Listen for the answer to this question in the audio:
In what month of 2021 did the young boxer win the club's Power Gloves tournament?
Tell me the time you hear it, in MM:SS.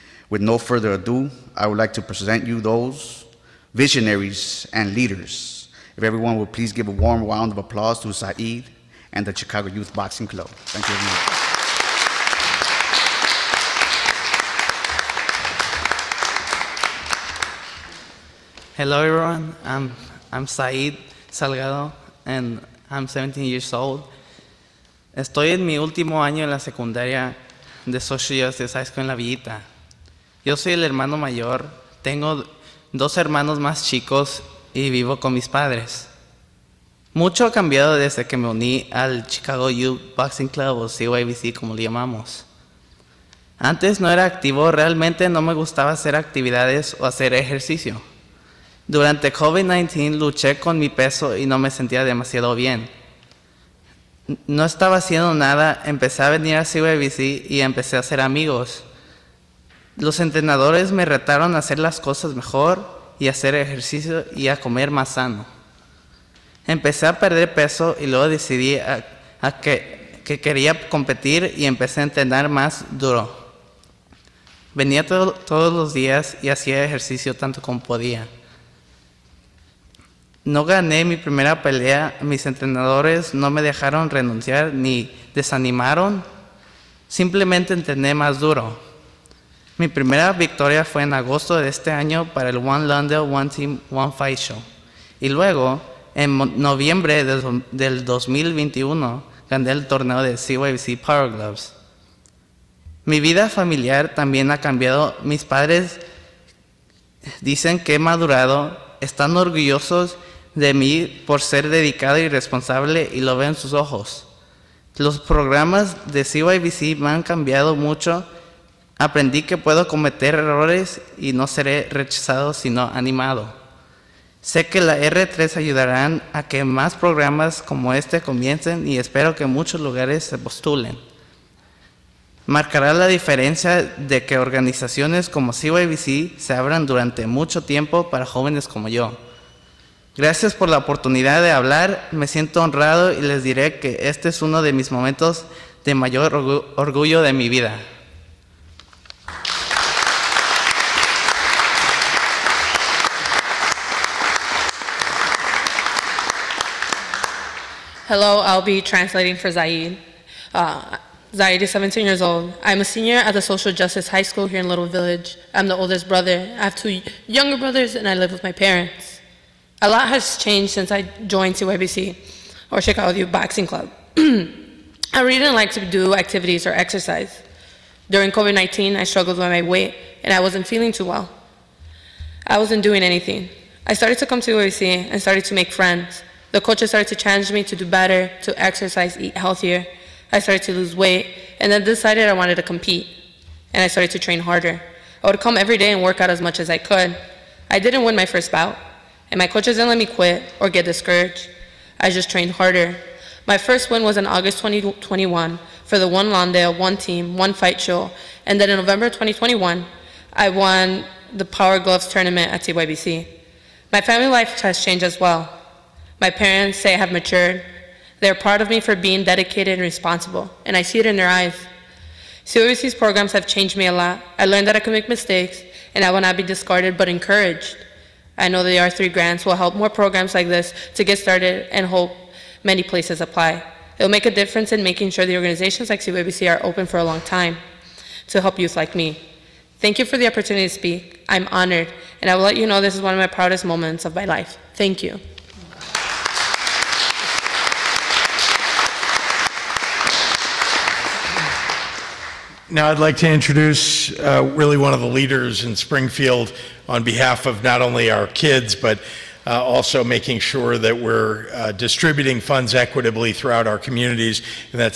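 01:36.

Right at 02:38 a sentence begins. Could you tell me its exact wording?
Hello, I'll be translating for Zaid.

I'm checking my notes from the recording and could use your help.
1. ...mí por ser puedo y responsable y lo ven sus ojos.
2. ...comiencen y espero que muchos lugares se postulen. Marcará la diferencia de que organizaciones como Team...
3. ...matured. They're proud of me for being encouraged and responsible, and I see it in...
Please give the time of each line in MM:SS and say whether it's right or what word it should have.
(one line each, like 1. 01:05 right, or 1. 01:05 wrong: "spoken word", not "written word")
1. 01:50 wrong: "dedicado", not "puedo"
2. 02:08 wrong: "CYBC", not "Team"
3. 03:37 wrong: "dedicated", not "encouraged".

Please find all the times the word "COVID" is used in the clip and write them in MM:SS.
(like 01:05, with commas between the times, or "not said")
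00:49, 02:58.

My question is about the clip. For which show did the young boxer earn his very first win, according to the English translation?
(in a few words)
One Lawndale, One Team, One Fight.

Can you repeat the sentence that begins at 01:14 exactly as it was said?
Venía todos los días y hacía ejercicio tanto como podía.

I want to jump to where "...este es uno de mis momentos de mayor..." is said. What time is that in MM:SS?
02:24.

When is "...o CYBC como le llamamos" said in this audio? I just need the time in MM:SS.
00:40.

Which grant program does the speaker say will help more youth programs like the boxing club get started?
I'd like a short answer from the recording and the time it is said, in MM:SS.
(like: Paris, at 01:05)
R3, at 03:48.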